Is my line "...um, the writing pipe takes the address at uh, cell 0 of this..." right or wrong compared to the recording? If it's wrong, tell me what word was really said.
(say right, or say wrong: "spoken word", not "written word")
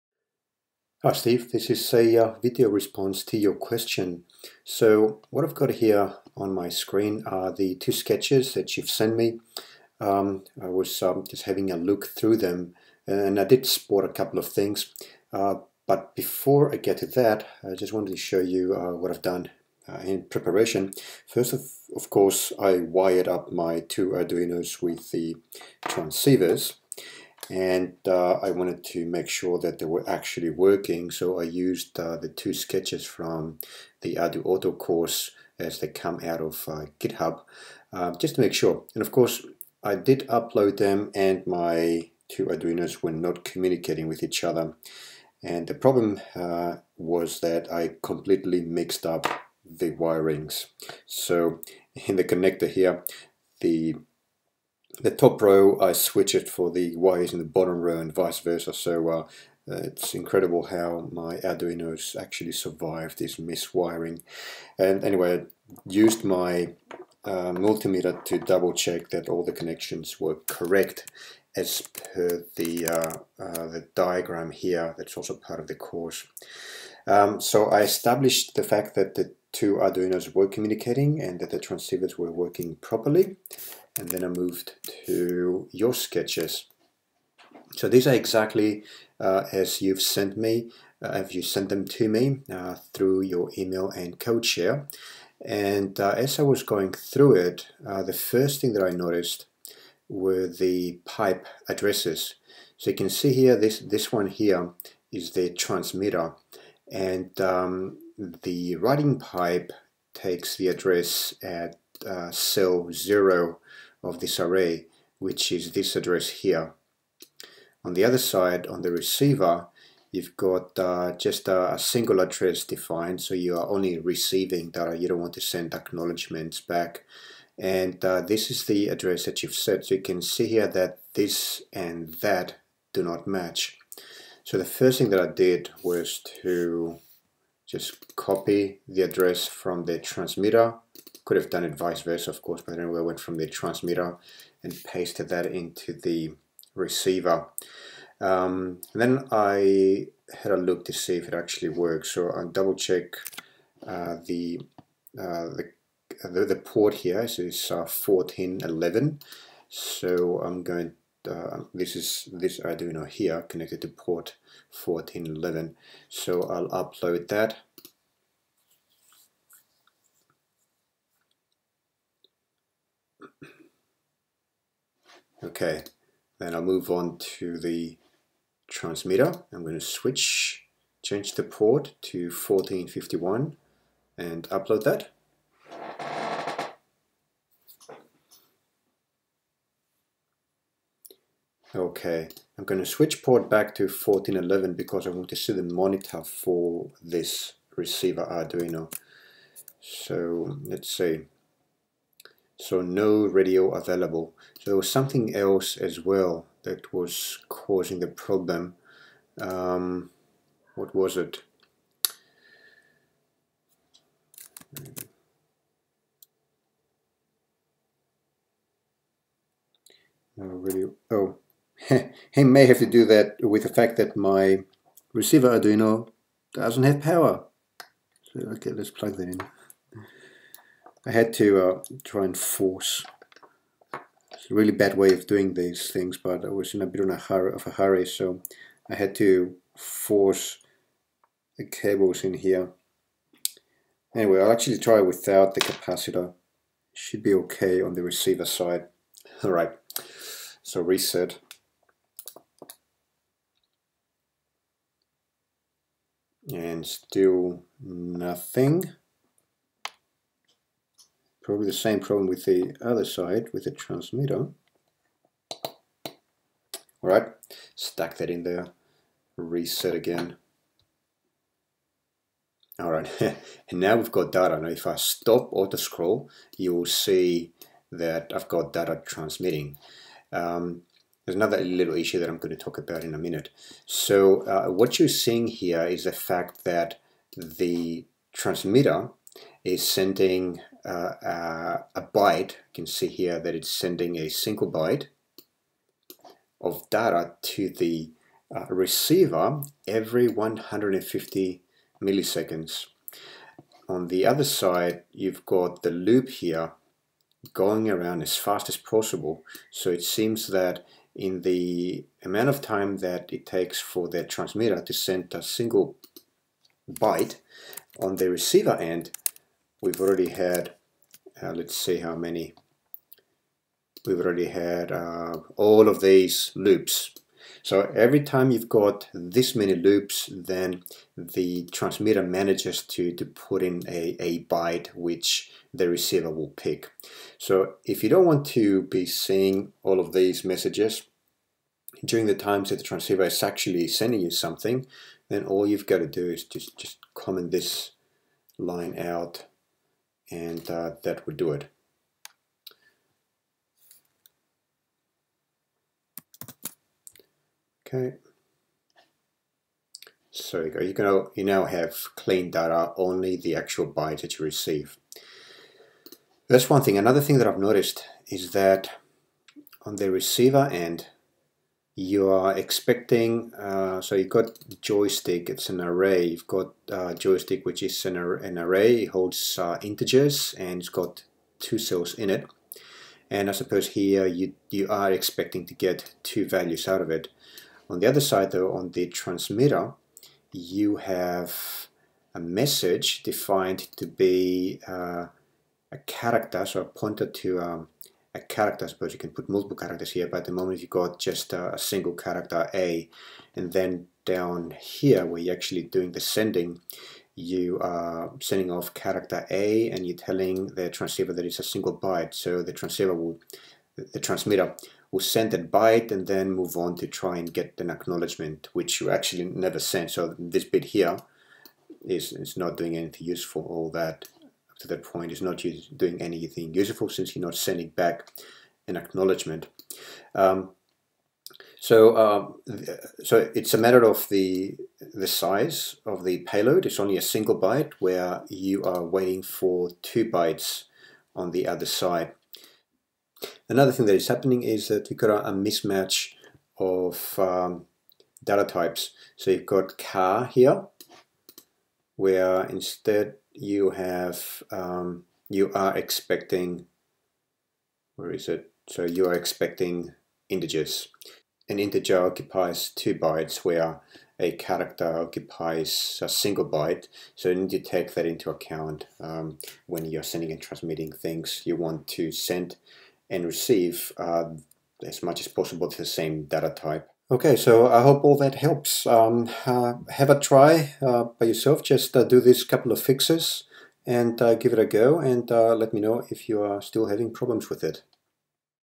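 right.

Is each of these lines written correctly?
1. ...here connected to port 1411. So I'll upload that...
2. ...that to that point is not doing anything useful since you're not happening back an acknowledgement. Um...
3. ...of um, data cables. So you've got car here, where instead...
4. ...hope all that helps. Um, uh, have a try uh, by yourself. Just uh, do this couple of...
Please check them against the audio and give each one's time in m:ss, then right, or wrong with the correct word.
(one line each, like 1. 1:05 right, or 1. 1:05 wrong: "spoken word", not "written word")
1. 2:43 right
2. 7:03 wrong: "sending", not "happening"
3. 7:26 wrong: "types", not "cables"
4. 7:58 right.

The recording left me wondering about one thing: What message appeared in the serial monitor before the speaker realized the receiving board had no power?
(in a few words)
no radio available.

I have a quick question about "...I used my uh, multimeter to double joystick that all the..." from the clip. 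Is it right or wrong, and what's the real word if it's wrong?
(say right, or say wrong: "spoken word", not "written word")
wrong: "check", not "joystick".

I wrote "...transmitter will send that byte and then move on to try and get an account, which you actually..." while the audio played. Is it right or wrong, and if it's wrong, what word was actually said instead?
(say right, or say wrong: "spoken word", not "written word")
wrong: "acknowledgement", not "account".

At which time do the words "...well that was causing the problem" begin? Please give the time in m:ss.
3:26.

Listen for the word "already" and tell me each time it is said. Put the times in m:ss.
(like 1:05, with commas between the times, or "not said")
5:19, 5:24.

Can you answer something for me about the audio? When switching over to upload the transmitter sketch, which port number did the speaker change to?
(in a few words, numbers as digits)
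1451.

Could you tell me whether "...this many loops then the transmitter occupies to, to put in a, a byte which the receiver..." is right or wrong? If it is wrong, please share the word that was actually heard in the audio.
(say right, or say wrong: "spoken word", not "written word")
wrong: "manages", not "occupies".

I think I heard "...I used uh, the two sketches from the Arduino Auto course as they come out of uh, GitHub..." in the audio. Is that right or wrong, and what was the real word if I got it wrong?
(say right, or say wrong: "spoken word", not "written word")
right.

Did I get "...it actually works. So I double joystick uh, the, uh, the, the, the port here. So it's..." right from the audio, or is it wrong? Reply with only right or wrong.
wrong.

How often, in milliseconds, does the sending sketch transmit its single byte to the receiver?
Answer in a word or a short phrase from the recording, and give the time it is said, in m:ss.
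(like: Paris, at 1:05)
150, at 5:00.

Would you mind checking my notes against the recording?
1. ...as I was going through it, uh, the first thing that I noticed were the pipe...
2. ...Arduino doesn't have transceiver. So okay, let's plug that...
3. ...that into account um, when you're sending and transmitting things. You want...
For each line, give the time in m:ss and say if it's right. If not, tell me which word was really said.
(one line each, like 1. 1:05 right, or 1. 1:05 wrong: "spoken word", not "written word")
1. 1:36 right
2. 3:45 wrong: "power", not "transceiver"
3. 7:48 right.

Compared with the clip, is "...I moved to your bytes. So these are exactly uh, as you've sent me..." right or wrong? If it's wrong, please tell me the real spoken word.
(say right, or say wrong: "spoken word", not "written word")
wrong: "sketches", not "bytes".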